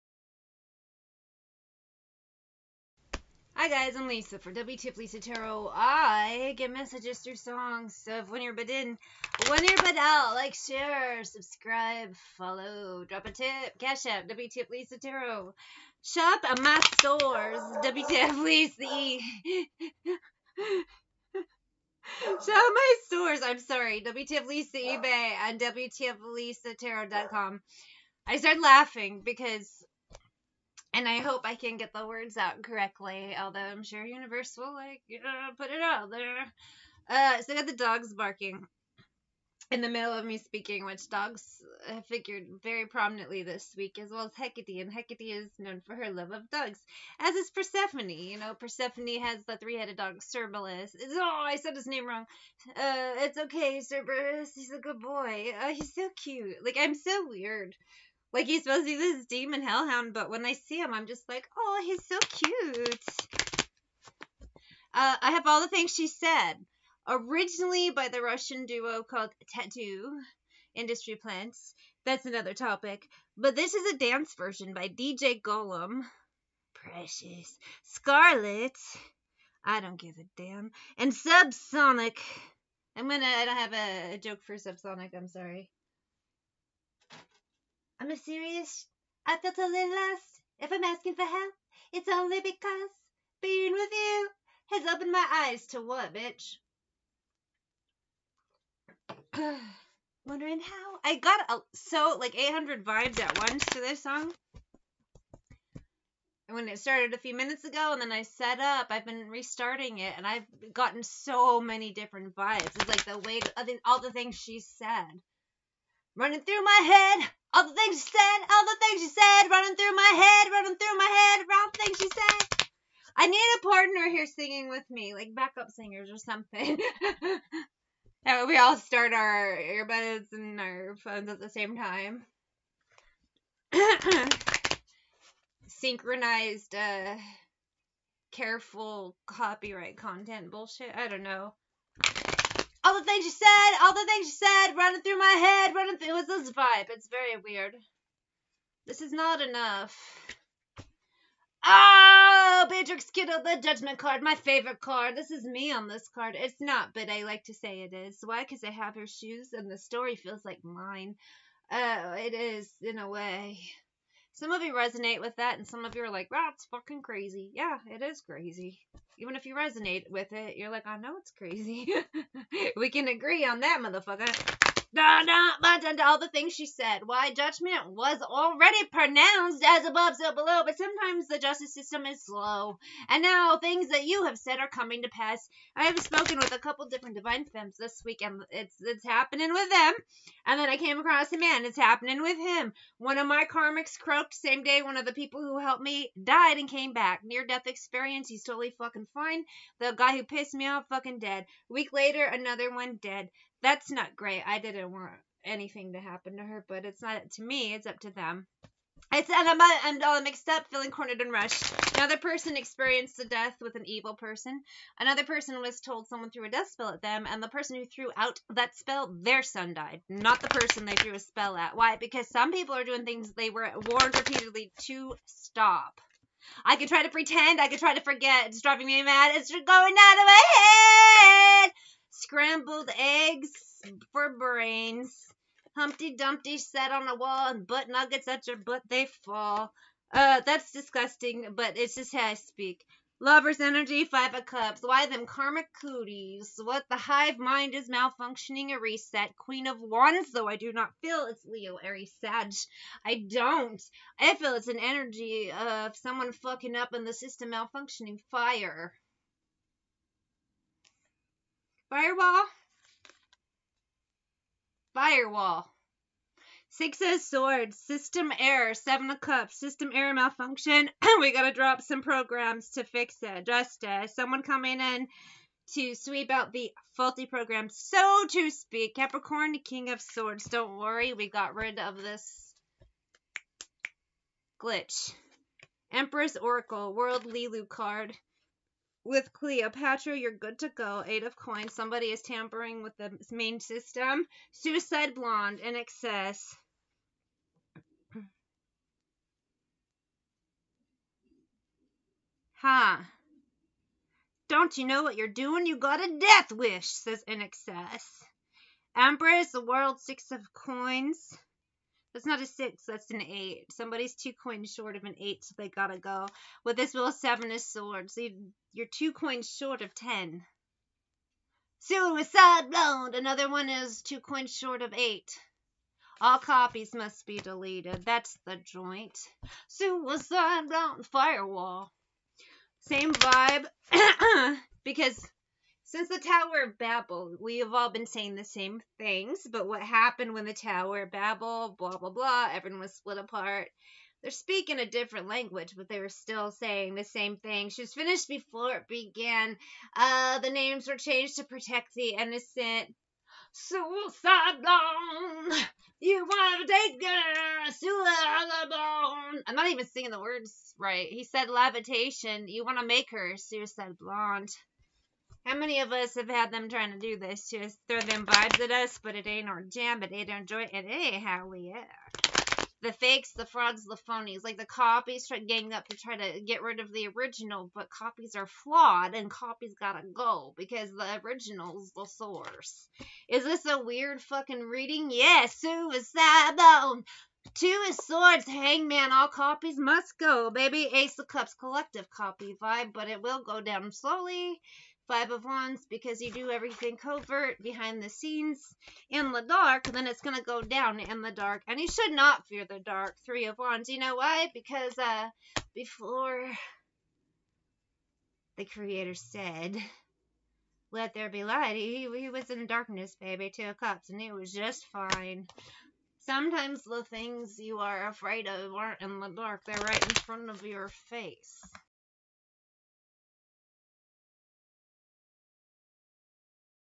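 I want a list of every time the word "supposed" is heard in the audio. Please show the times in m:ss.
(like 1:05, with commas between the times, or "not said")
0:58.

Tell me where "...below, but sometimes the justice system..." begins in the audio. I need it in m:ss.
3:00.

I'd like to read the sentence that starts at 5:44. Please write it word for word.
They're speaking a different language, but they were still saying the same thing.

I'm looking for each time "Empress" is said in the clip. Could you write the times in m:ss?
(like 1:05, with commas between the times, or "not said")
4:45, 5:08.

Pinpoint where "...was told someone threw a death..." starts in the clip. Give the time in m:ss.
3:35.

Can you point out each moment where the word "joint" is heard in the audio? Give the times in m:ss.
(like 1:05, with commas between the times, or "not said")
5:28.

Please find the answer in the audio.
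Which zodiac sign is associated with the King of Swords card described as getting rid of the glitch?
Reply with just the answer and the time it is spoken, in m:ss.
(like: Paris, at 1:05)
Capricorn, at 4:38.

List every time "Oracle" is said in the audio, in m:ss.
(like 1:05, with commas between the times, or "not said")
4:46.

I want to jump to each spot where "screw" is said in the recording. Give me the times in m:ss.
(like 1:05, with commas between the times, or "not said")
not said.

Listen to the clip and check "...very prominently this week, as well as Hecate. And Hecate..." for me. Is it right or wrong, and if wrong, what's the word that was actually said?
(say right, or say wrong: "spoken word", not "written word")
right.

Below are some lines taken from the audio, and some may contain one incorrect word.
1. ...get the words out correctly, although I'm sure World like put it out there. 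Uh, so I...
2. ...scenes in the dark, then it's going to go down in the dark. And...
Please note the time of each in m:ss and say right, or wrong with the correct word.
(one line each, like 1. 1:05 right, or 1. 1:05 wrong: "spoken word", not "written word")
1. 0:31 wrong: "Universal", not "World"
2. 6:38 right.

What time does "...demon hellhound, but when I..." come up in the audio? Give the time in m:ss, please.
0:59.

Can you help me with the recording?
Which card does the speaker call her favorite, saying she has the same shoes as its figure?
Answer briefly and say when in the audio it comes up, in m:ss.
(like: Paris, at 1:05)
judgment card, at 2:33.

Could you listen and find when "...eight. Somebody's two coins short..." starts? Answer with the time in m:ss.
5:13.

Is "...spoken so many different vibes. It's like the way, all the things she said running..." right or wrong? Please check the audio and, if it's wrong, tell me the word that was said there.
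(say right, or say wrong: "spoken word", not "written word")
wrong: "gotten", not "spoken".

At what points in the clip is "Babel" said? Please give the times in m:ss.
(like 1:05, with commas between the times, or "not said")
5:36, 5:41.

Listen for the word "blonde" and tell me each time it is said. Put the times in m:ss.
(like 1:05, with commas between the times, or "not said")
4:55, 5:22, 5:30, 5:58, 6:03.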